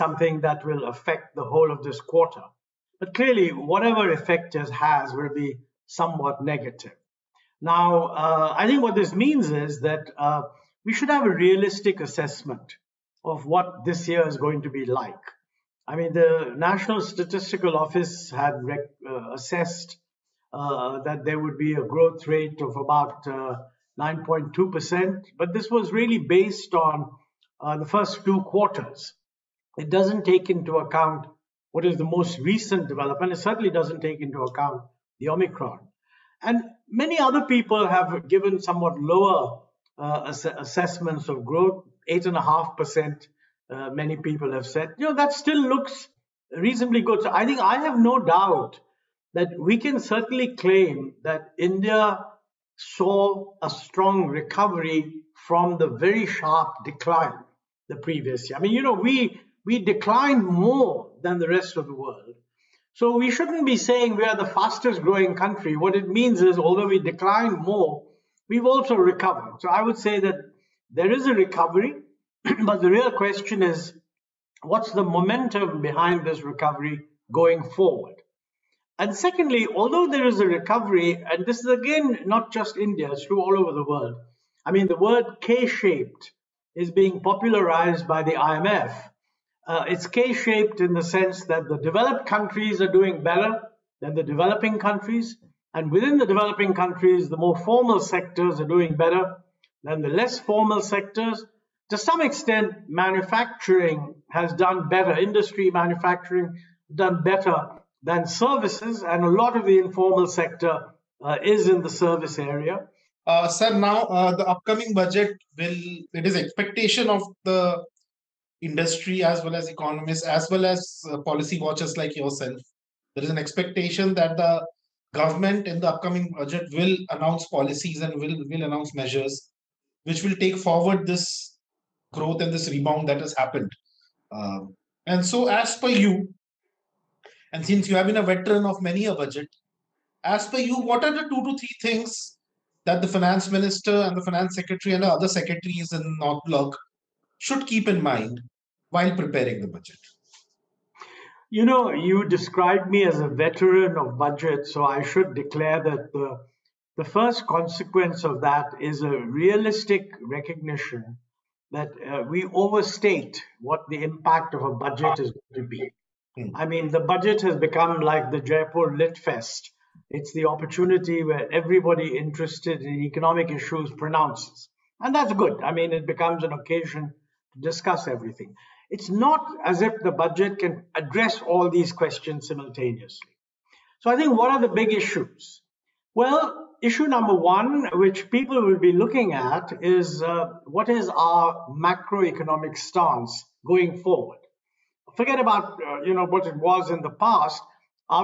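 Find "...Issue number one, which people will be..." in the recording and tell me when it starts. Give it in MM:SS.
03:06.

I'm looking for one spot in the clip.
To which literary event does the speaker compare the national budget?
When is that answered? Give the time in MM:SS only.
02:48.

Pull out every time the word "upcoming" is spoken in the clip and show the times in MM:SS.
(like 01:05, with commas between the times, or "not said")
01:54, 02:05.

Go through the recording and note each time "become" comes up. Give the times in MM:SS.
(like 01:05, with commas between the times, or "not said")
02:47, 02:56.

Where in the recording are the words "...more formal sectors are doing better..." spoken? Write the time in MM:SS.
01:37.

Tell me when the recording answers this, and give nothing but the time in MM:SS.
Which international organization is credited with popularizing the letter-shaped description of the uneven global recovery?
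01:28.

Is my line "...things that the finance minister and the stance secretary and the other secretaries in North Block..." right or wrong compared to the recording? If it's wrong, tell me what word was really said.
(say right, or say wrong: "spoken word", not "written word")
wrong: "finance", not "stance".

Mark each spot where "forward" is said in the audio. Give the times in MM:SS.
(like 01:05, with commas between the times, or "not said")
01:17, 02:10, 03:14.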